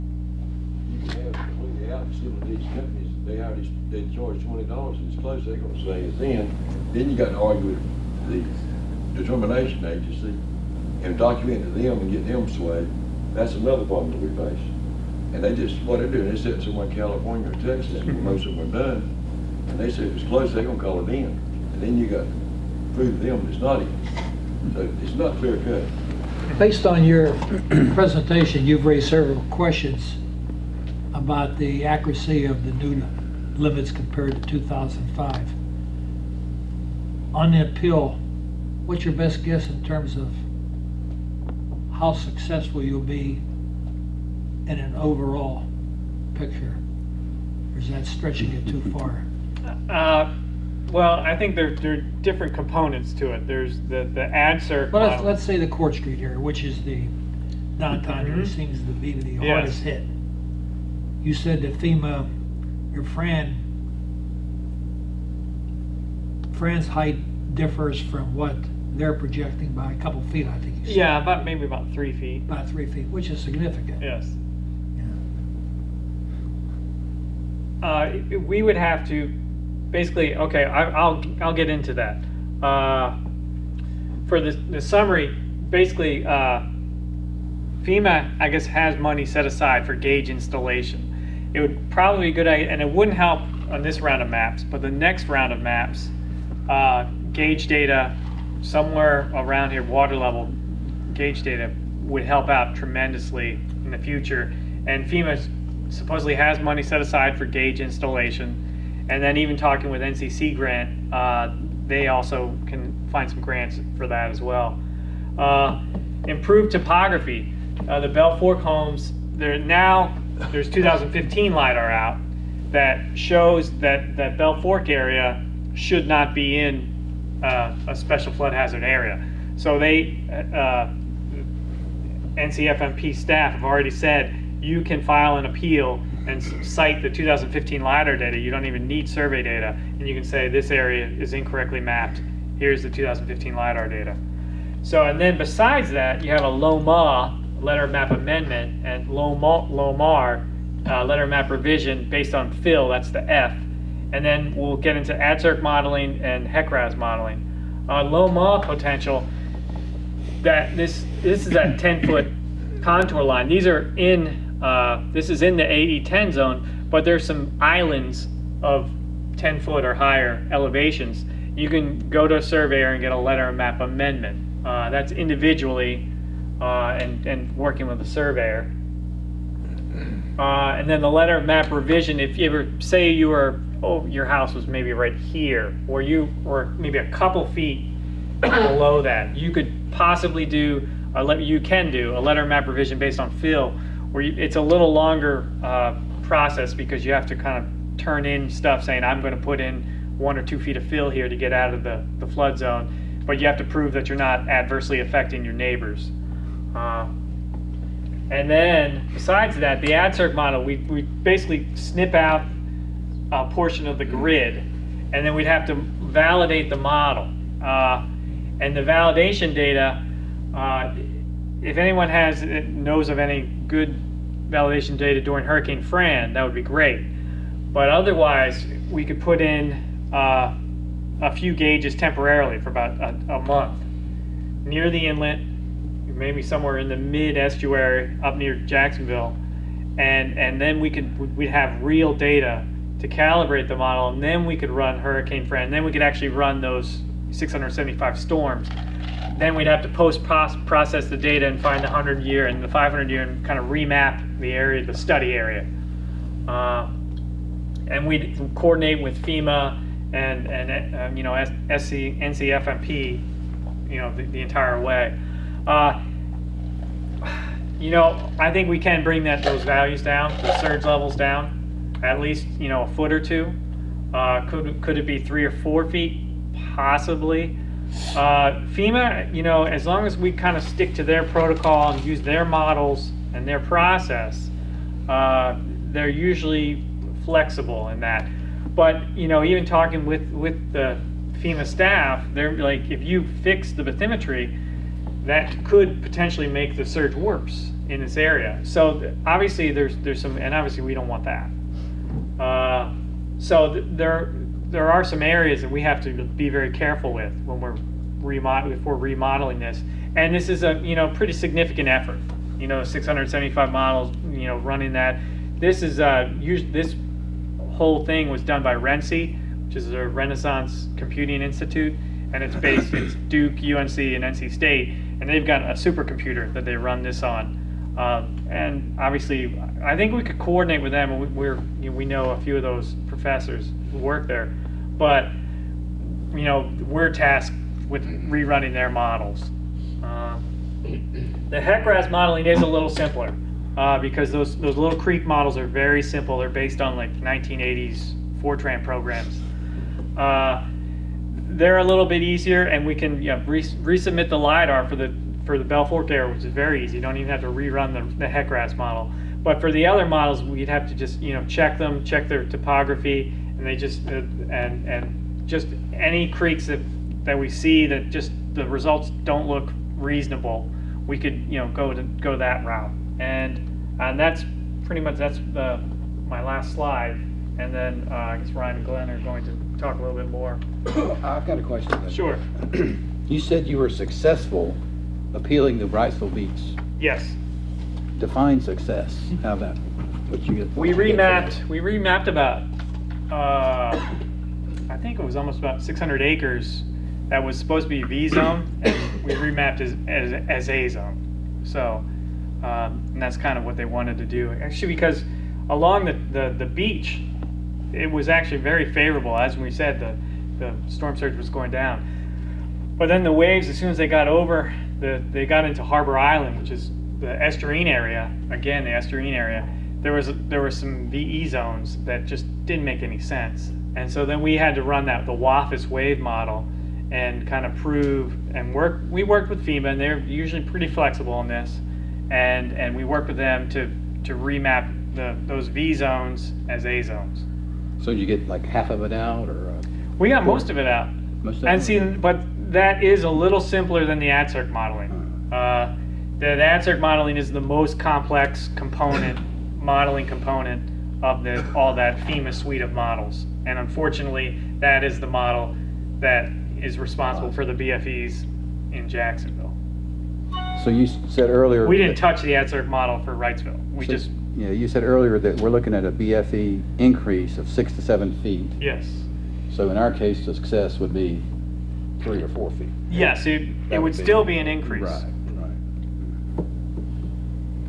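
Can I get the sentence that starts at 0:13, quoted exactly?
That's another problem that we face.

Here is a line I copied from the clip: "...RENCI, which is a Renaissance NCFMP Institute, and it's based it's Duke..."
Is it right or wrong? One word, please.
wrong.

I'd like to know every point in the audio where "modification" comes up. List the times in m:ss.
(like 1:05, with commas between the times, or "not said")
not said.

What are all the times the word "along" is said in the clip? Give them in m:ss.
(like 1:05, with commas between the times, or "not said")
6:45.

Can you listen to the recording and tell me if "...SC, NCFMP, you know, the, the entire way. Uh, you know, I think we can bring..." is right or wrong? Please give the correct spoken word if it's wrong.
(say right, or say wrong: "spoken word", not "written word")
right.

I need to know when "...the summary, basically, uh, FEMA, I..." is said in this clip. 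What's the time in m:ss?
1:24.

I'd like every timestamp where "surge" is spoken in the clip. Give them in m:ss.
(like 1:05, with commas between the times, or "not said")
4:30, 4:56, 6:51.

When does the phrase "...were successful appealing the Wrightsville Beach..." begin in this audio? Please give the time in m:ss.
6:23.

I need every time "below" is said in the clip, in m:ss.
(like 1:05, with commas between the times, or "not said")
3:08.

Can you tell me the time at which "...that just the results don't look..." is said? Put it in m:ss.
6:07.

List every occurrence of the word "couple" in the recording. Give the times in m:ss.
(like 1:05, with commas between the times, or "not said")
1:09, 3:07.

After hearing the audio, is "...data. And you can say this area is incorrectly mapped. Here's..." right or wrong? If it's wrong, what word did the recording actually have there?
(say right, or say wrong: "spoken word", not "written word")
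right.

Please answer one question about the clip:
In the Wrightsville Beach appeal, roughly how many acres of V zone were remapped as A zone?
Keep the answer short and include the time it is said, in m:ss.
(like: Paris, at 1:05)
about 600 acres, at 6:35.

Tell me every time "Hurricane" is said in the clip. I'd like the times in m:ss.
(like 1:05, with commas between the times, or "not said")
3:45, 4:04.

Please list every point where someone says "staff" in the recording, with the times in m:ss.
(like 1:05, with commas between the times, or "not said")
2:13, 4:51.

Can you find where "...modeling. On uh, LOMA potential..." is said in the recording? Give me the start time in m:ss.
2:36.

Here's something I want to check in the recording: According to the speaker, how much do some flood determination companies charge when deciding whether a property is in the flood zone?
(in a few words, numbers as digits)
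$20.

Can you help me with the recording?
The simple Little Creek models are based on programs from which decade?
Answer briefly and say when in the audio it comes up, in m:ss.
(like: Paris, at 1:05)
1980s, at 5:47.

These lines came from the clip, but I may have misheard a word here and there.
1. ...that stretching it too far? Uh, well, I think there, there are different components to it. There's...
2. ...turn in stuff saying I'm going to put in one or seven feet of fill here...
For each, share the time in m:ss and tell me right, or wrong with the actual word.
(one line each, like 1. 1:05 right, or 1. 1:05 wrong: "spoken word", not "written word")
1. 0:47 right
2. 3:17 wrong: "two", not "seven".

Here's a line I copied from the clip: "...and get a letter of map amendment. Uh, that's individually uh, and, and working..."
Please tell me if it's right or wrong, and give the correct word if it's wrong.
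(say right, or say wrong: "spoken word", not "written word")
right.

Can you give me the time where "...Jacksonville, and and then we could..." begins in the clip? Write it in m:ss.
3:58.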